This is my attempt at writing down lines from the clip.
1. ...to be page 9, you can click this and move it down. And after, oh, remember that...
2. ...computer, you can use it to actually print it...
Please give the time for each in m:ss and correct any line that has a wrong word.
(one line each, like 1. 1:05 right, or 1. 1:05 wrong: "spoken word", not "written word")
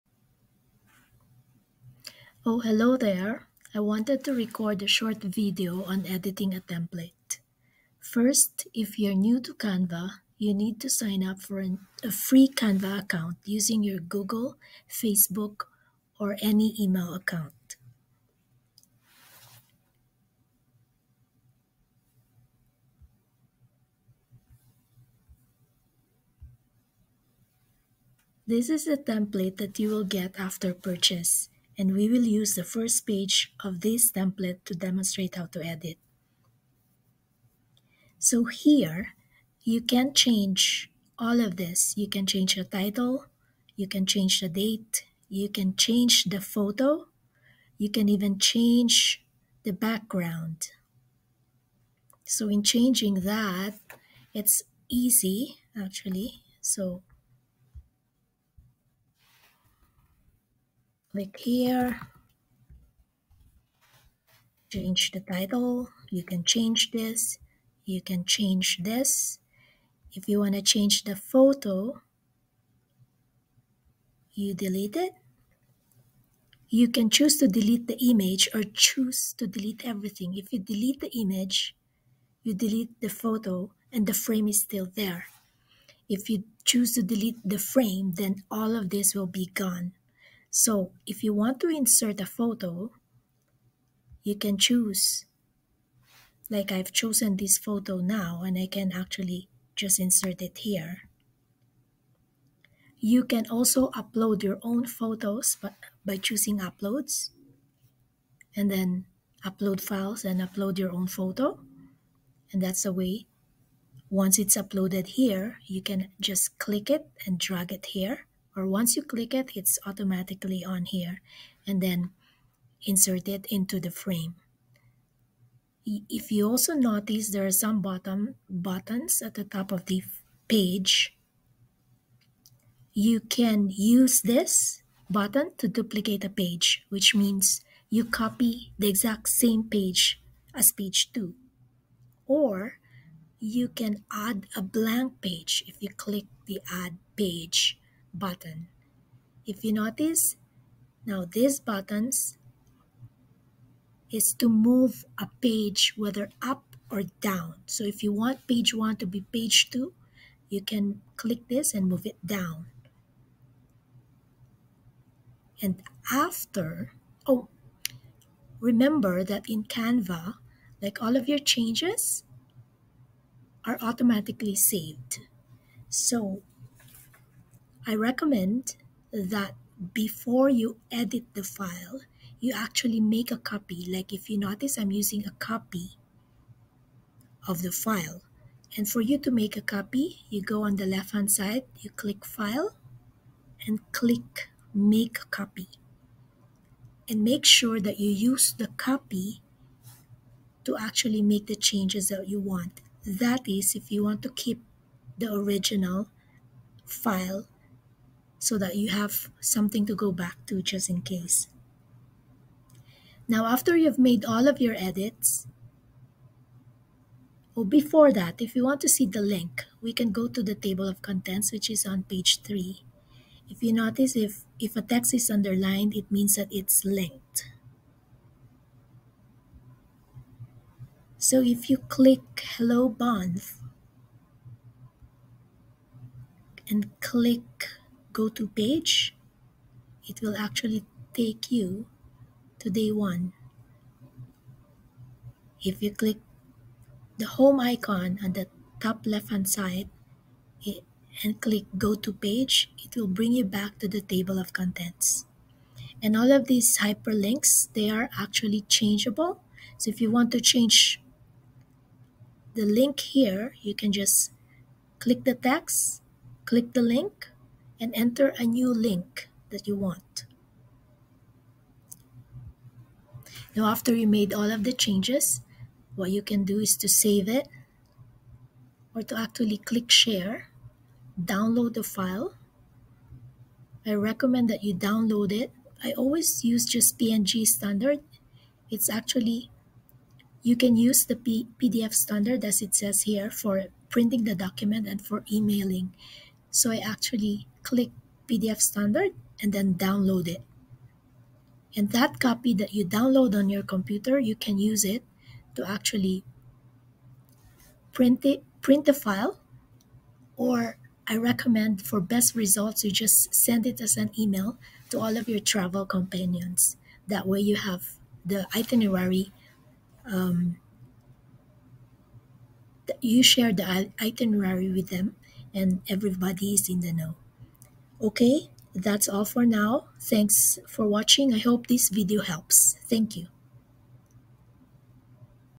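1. 2:38 wrong: "2", not "9"
2. 5:03 right.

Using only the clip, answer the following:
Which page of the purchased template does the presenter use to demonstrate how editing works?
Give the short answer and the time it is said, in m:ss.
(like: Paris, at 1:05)
first page, at 0:32.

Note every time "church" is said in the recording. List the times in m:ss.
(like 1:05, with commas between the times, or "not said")
not said.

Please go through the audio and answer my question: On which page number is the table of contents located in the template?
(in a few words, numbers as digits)
3.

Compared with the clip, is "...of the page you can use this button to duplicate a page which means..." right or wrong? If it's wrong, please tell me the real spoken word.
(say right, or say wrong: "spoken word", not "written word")
right.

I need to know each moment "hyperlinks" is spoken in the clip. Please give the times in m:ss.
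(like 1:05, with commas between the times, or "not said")
4:16.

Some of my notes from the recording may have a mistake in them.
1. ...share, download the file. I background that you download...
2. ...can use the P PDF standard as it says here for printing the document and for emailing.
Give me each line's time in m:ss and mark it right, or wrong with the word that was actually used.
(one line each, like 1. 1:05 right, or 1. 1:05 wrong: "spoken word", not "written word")
1. 4:39 wrong: "recommend", not "background"
2. 4:50 right.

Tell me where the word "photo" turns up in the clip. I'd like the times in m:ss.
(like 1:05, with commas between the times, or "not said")
0:46, 1:11, 1:23, 1:32, 1:37, 1:44, 1:51.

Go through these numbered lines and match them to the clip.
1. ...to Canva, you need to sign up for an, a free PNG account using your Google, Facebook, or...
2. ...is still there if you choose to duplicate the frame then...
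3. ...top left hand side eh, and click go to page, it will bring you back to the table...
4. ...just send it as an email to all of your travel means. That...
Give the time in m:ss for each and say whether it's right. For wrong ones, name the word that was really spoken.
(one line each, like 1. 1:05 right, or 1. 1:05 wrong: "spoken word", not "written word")
1. 0:09 wrong: "Canva", not "PNG"
2. 1:24 wrong: "delete", not "duplicate"
3. 4:08 right
4. 5:12 wrong: "companions", not "means".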